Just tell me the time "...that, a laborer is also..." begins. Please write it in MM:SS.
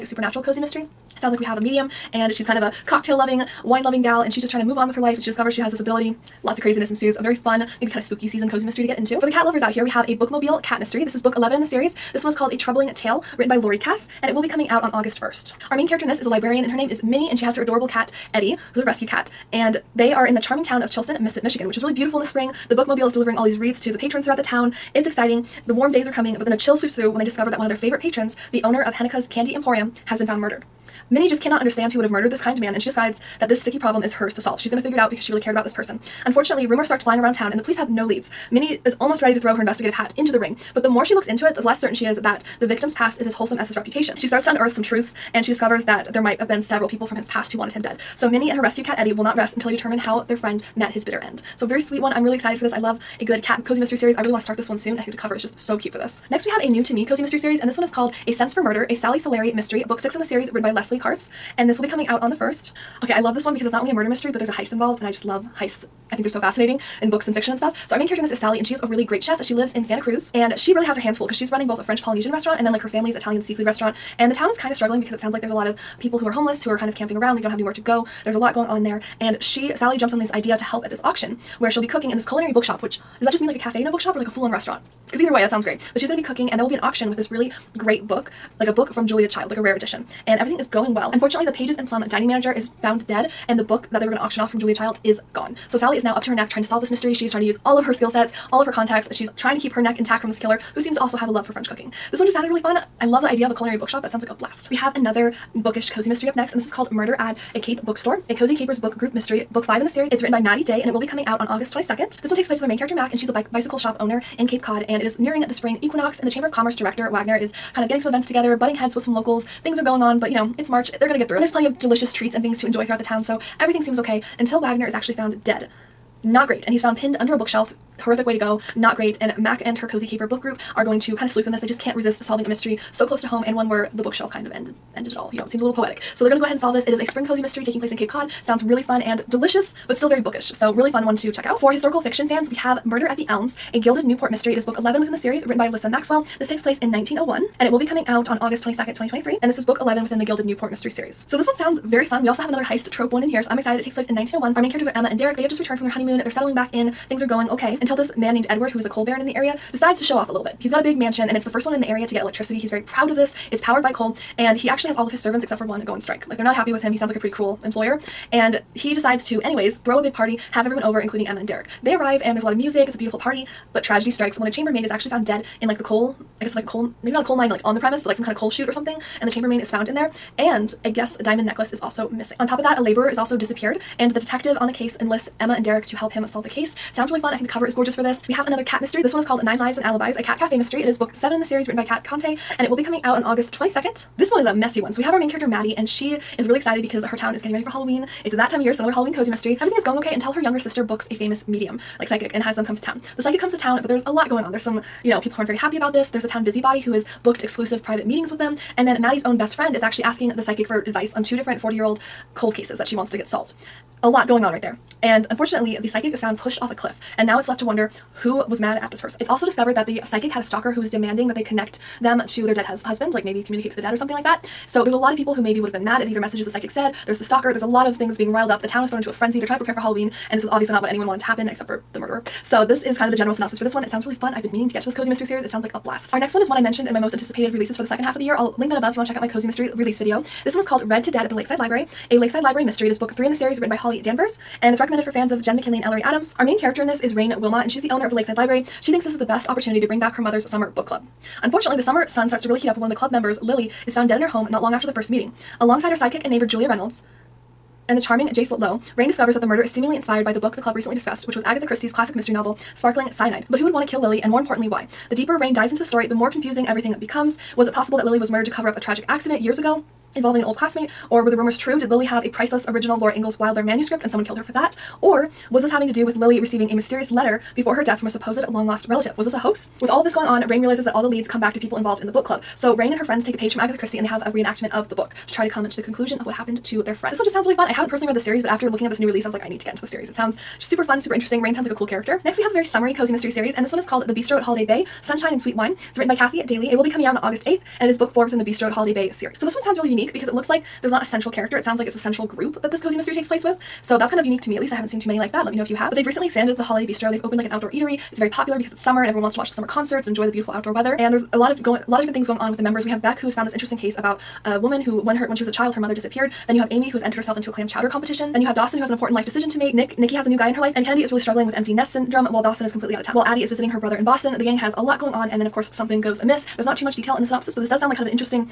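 03:02.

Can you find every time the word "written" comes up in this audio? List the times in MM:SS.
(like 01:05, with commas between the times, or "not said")
00:13, 01:00, 01:50, 02:25, 03:11, 04:03, 04:55.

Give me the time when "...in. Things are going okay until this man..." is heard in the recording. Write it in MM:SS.
02:36.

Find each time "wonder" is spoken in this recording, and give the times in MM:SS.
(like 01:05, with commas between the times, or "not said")
03:37.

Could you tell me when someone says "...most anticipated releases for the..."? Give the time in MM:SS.
03:56.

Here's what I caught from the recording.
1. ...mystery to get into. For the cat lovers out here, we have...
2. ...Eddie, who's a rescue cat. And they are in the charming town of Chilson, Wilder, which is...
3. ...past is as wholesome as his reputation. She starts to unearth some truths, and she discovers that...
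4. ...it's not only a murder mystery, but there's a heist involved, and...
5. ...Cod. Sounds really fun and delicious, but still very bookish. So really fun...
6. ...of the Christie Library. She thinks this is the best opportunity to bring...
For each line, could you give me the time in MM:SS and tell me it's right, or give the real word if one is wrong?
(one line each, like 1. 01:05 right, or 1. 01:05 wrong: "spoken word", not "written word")
1. 00:08 right
2. 00:18 wrong: "Michigan", not "Wilder"
3. 00:42 right
4. 01:03 right
5. 02:18 right
6. 04:08 wrong: "Lakeside", not "Christie".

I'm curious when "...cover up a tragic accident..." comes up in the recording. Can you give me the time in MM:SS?
04:28.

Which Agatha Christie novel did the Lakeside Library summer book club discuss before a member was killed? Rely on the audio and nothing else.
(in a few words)
Sparkling Cyanide.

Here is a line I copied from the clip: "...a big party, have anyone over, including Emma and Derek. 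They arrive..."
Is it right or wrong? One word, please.
wrong.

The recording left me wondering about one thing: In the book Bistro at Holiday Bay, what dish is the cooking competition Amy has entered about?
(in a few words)
Clam chowder.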